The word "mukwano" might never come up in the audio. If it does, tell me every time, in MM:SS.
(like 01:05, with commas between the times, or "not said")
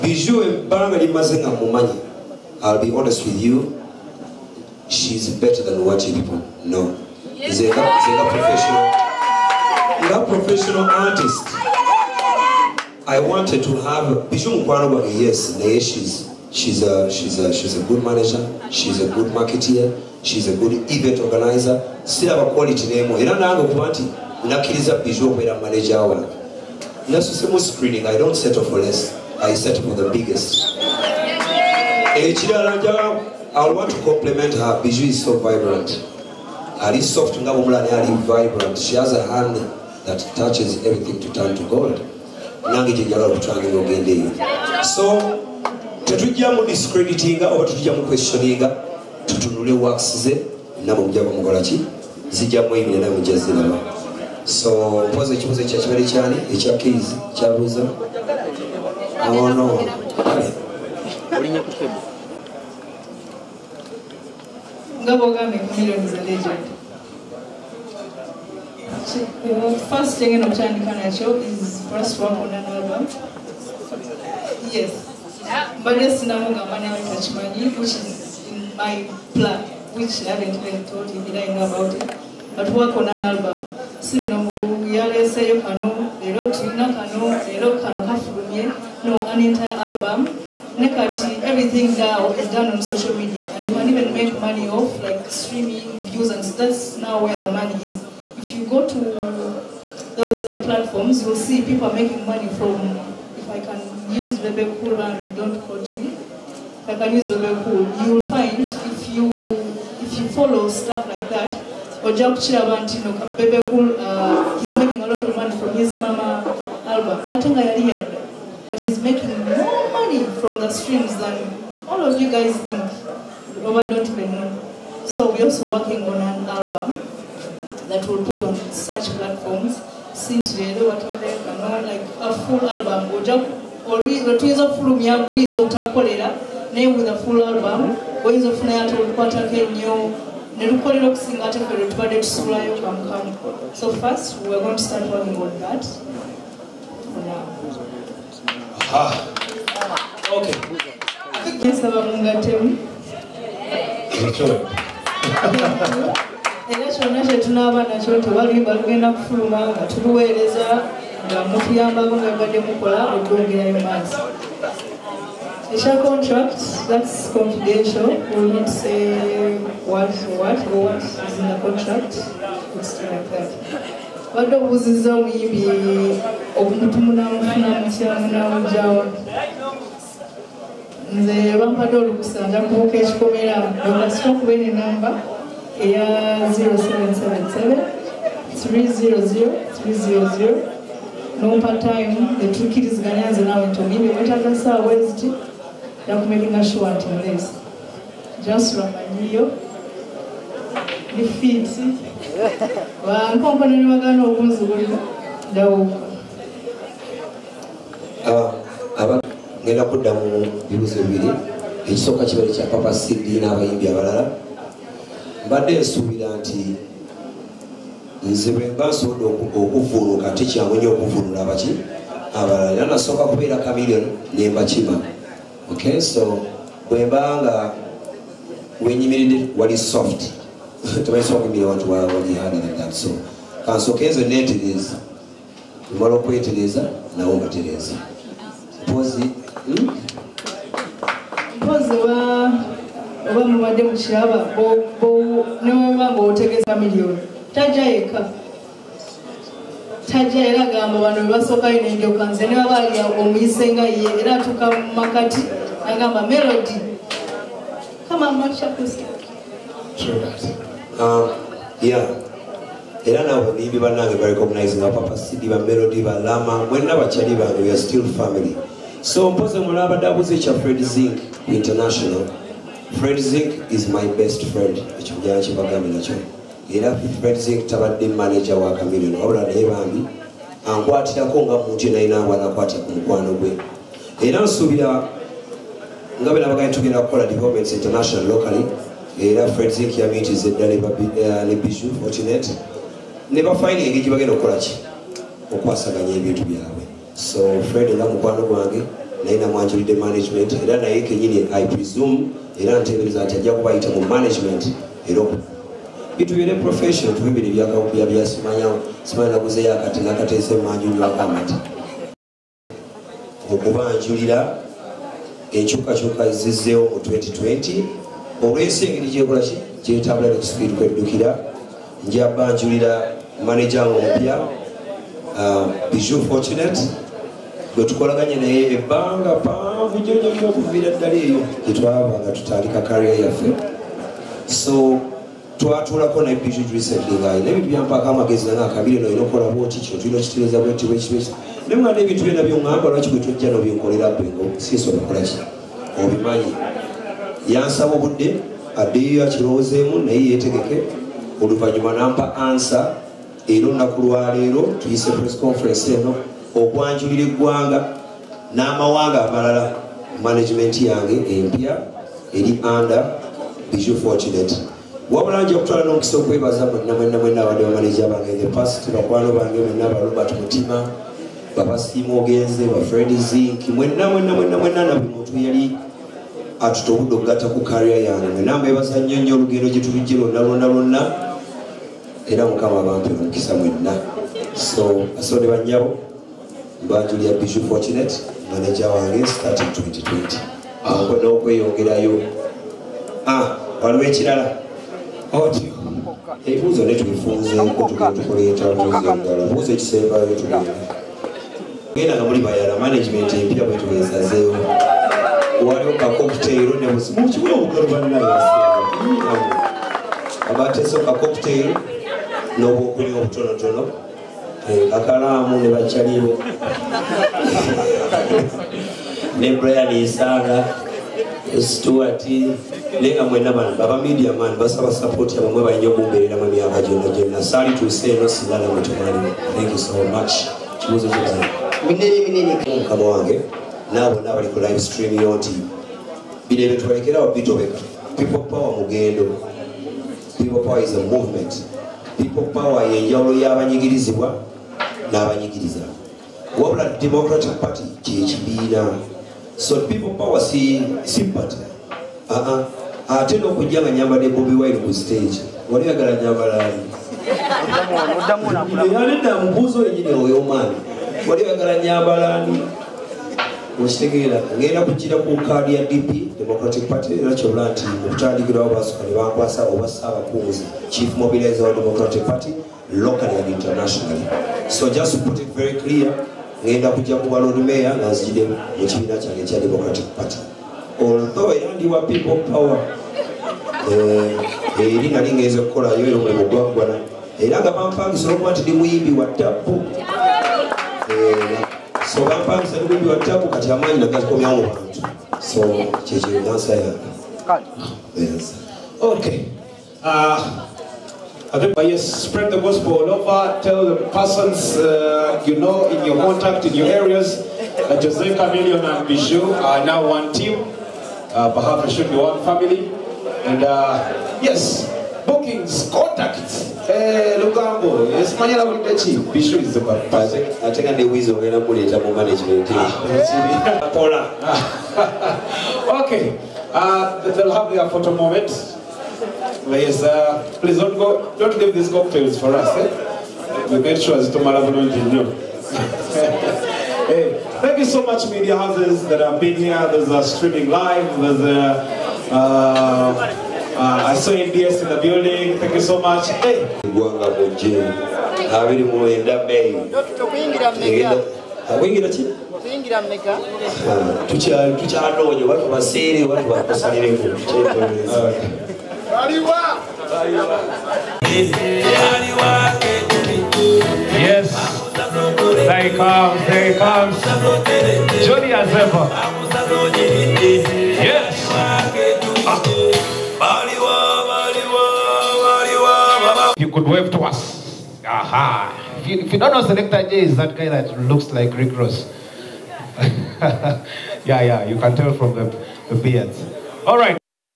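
04:42, 04:58.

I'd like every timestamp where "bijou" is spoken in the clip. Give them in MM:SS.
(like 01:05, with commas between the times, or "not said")
05:25, 08:29.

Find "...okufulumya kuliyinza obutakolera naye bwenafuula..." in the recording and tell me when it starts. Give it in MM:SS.
02:14.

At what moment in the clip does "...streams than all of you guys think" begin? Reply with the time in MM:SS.
02:00.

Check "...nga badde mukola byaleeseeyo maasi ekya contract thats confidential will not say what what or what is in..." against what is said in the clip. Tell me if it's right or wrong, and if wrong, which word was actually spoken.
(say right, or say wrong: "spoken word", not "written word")
wrong: "okwogerayo", not "byaleeseeyo".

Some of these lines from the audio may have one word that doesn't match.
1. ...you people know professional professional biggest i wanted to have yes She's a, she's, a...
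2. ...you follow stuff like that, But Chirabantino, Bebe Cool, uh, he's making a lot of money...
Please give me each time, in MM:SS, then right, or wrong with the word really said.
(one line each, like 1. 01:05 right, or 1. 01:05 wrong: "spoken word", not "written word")
1. 00:06 wrong: "artist", not "biggest"
2. 01:50 wrong: "Ojak", not "But".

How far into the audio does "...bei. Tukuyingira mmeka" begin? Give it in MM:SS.
09:09.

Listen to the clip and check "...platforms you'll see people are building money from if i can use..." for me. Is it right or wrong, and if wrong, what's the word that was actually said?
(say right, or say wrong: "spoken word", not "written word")
wrong: "making", not "building".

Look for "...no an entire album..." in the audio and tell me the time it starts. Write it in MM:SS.
01:29.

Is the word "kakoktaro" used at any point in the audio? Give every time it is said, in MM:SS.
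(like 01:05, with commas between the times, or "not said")
06:46, 06:51.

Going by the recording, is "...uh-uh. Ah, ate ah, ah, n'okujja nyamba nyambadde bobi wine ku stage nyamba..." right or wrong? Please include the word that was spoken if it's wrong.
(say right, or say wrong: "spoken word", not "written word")
right.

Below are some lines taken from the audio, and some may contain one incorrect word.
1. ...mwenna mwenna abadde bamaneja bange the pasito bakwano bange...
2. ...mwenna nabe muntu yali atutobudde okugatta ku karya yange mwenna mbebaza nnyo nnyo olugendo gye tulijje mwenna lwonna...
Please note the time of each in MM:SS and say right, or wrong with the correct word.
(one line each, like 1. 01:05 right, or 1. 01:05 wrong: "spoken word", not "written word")
1. 06:06 right
2. 06:14 wrong: "lwonna", not "mwenna".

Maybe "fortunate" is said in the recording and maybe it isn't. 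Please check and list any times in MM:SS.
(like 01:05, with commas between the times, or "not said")
04:52, 05:26, 06:27.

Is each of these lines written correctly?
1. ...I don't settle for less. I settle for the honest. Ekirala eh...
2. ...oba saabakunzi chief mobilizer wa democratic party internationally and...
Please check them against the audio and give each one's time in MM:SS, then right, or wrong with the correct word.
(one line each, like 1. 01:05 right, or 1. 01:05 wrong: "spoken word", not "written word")
1. 00:28 wrong: "biggest", not "honest"
2. 07:49 wrong: "locally", not "internationally".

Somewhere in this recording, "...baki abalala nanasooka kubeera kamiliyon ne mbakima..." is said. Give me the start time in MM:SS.
03:41.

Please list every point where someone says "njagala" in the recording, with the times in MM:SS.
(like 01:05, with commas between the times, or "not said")
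00:32, 00:43.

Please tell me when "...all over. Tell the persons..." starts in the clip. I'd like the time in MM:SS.
08:22.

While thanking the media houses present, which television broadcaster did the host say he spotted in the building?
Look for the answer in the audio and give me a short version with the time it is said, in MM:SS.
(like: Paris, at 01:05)
NBS, at 09:04.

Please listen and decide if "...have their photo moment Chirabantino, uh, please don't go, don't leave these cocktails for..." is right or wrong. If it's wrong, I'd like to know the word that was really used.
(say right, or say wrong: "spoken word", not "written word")
wrong: "Yes", not "Chirabantino".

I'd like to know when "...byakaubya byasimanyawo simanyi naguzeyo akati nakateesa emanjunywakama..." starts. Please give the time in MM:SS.
05:07.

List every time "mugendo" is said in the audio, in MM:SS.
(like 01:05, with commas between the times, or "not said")
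07:18.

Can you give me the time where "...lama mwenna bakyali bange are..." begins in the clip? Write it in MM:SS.
04:26.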